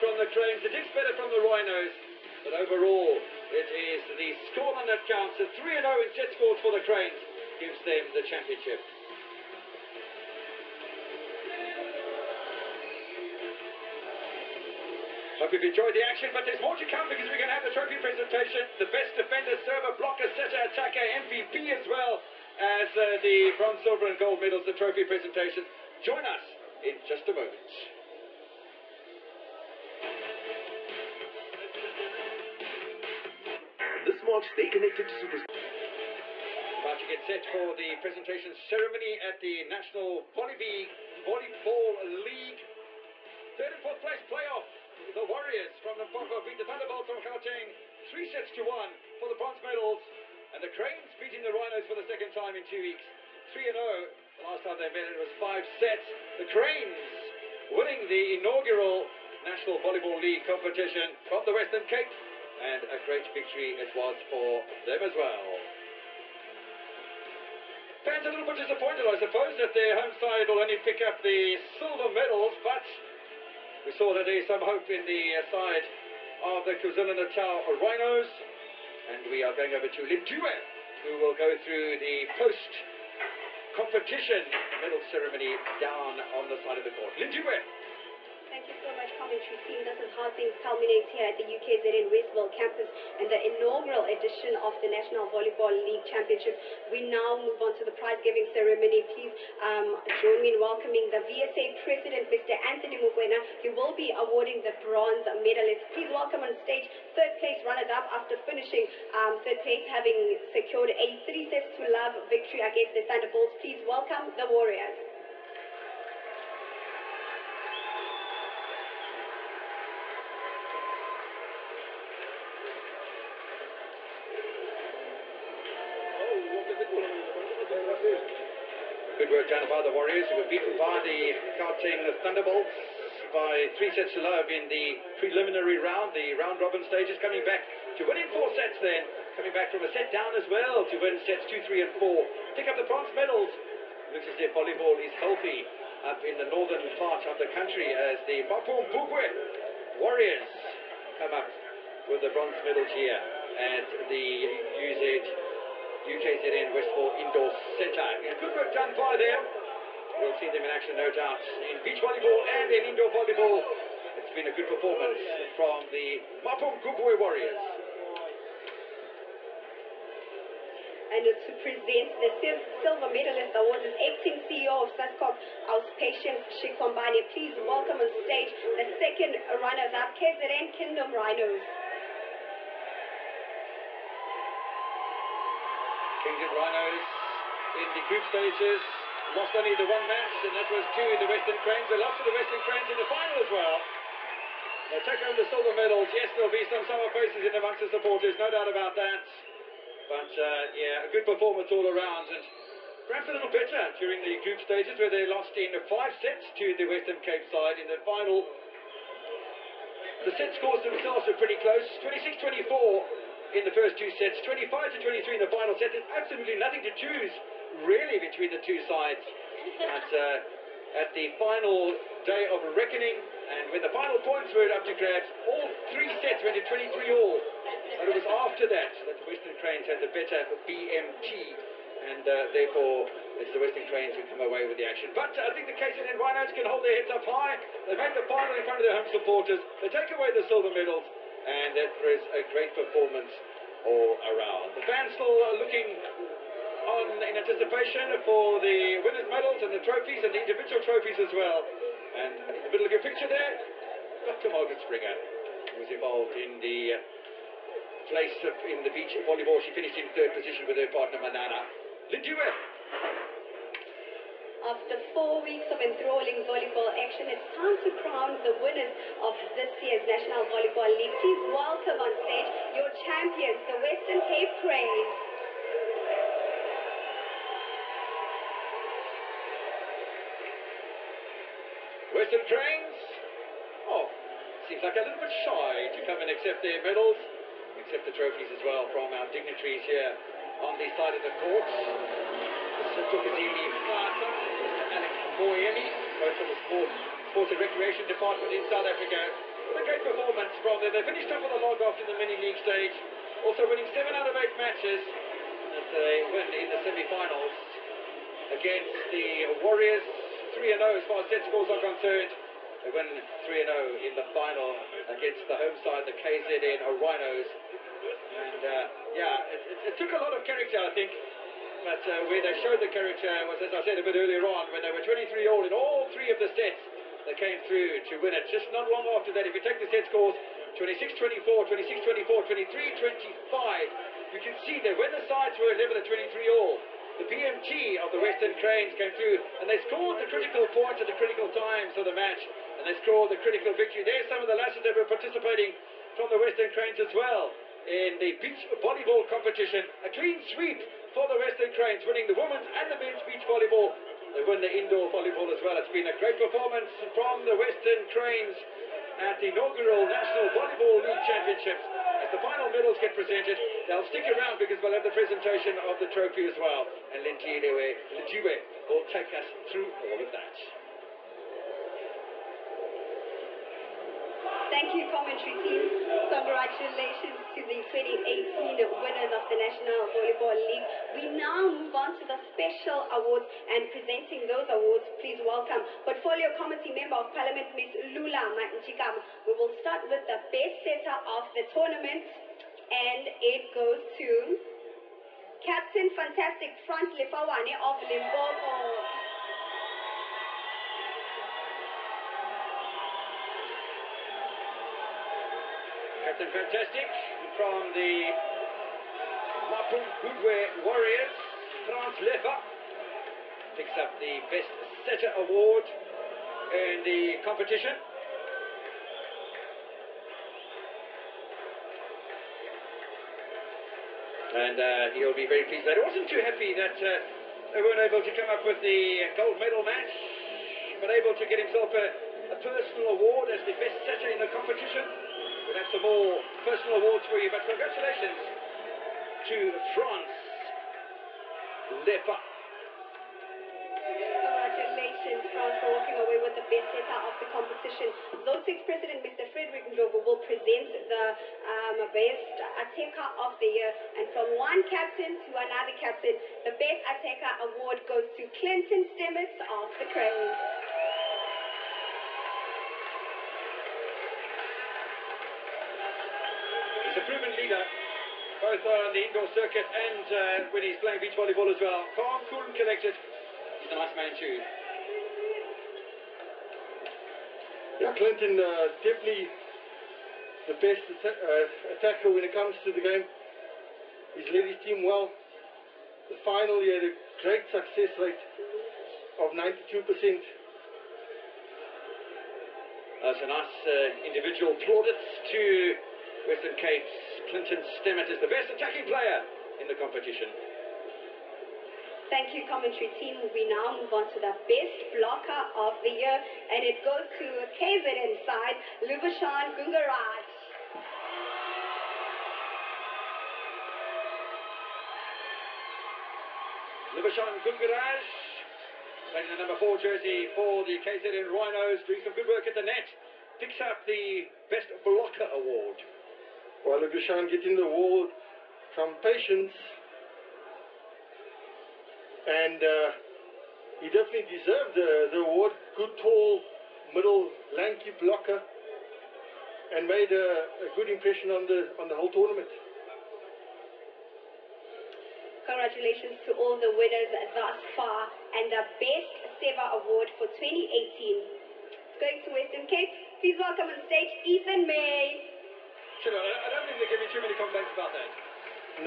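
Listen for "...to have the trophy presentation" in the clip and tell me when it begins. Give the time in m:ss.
0:17.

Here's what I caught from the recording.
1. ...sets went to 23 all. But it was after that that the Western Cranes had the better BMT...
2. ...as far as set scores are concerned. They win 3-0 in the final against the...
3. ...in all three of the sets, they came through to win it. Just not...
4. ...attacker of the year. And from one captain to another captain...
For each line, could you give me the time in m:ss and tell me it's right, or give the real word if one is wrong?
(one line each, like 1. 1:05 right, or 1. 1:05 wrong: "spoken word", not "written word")
1. 3:46 right
2. 5:10 right
3. 5:25 right
4. 7:32 right.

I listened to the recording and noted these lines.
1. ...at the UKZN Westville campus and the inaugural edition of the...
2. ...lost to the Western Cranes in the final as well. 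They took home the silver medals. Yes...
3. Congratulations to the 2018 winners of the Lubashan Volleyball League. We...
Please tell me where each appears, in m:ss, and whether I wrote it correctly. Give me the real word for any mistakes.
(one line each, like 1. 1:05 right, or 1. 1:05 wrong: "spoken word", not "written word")
1. 1:31 right
2. 3:11 right
3. 6:16 wrong: "National", not "Lubashan".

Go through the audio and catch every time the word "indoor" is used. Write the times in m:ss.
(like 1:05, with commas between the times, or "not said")
2:37, 2:42, 5:54, 7:49.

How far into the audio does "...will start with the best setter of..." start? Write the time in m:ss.
6:29.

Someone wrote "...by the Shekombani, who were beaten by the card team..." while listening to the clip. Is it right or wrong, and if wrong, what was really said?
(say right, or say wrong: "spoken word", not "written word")
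wrong: "Warriors", not "Shekombani".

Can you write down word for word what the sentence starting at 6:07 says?
And Lindiwe will take us through all of that.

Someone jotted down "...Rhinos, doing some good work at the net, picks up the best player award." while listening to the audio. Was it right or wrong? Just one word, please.
wrong.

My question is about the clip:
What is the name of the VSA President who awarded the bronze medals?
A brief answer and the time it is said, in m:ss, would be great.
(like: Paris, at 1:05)
Anthony Mukwena, at 1:42.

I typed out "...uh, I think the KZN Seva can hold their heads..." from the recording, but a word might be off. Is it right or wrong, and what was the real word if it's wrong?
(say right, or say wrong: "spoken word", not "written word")
wrong: "Rhinos", not "Seva".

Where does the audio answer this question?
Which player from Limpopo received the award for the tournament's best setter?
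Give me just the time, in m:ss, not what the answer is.
6:36.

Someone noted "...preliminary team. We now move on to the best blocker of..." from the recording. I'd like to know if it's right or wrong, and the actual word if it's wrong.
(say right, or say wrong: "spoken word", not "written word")
wrong: "commentary", not "preliminary".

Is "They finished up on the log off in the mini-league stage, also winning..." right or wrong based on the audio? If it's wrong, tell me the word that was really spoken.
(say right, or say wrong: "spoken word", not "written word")
right.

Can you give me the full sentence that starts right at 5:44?
There's some of the lasses that were participating from the Western Cranes as well in the beach volleyball competition.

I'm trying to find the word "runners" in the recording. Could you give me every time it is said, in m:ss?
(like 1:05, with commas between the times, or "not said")
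1:47, 2:59.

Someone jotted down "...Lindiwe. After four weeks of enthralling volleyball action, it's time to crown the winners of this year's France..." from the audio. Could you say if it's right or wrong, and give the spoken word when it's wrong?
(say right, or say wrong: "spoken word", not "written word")
wrong: "National", not "France".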